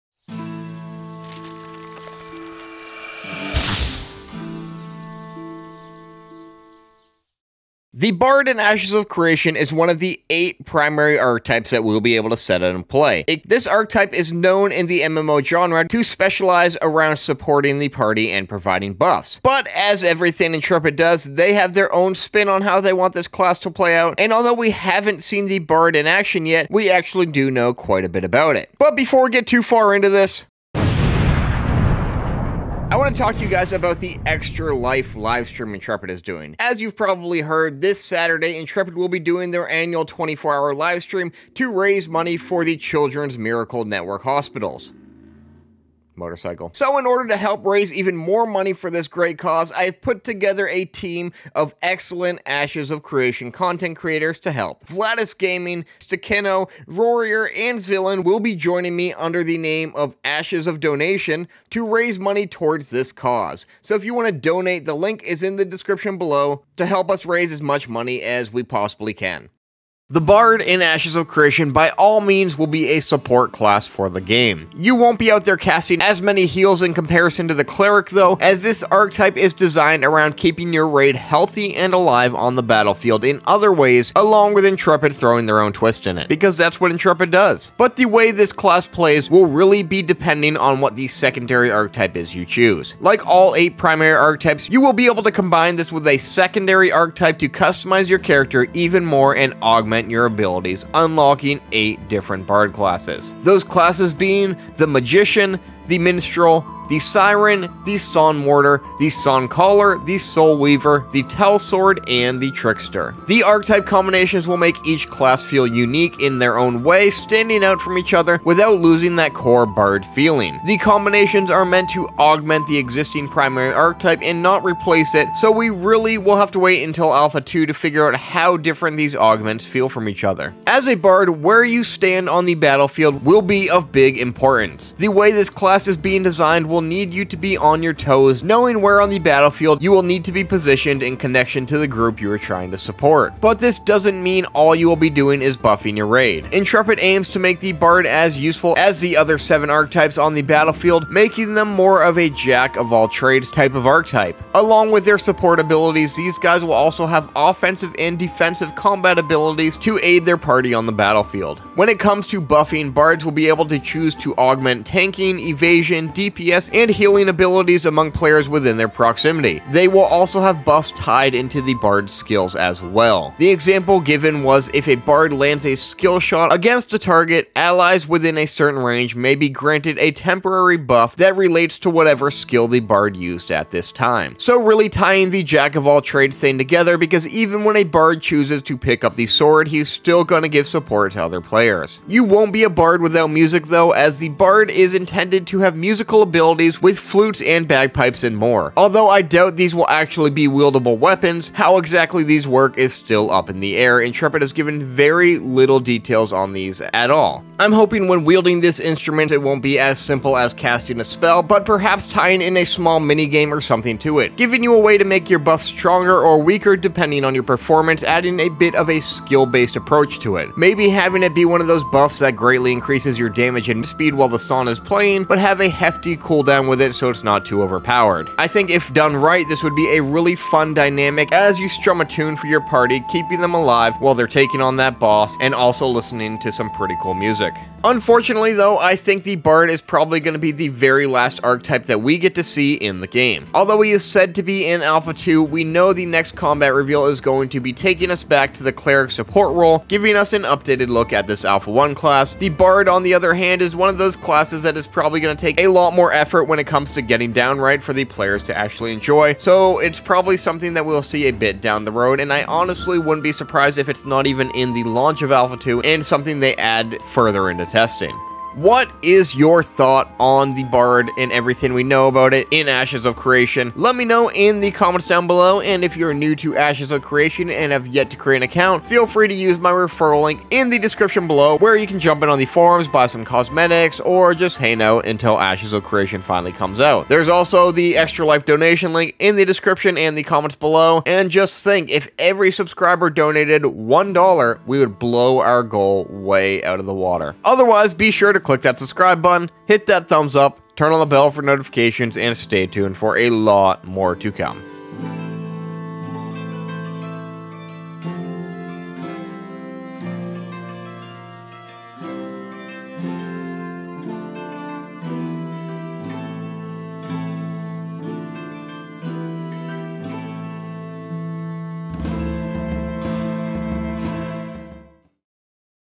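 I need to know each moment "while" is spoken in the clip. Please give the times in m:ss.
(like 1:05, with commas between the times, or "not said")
3:44, 3:53.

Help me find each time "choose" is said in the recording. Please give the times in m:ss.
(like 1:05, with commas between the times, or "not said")
1:32, 2:43, 3:08.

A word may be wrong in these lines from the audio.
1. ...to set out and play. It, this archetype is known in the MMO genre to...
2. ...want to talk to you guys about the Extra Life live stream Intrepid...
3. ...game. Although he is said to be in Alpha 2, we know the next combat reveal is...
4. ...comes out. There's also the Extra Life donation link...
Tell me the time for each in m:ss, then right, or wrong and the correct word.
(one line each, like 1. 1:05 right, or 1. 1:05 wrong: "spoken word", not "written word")
1. 0:12 right
2. 0:32 right
3. 4:03 right
4. 4:46 right.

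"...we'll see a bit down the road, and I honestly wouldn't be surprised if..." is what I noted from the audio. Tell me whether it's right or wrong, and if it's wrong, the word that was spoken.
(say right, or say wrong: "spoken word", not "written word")
right.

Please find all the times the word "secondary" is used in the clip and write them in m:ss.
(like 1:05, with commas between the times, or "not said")
1:31, 1:36.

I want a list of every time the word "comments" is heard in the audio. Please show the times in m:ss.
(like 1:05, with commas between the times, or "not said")
4:34, 4:50.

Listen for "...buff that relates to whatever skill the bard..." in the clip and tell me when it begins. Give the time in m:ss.
3:00.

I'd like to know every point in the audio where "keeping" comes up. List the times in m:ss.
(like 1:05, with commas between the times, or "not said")
1:20, 3:53.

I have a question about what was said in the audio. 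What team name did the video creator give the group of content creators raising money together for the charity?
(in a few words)
Ashes of Donation.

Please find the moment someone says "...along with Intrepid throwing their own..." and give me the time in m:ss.
1:24.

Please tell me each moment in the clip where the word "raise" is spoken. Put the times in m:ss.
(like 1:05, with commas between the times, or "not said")
0:41, 0:47, 1:01, 1:07.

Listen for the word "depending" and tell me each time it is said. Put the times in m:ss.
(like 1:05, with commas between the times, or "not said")
1:30, 3:36.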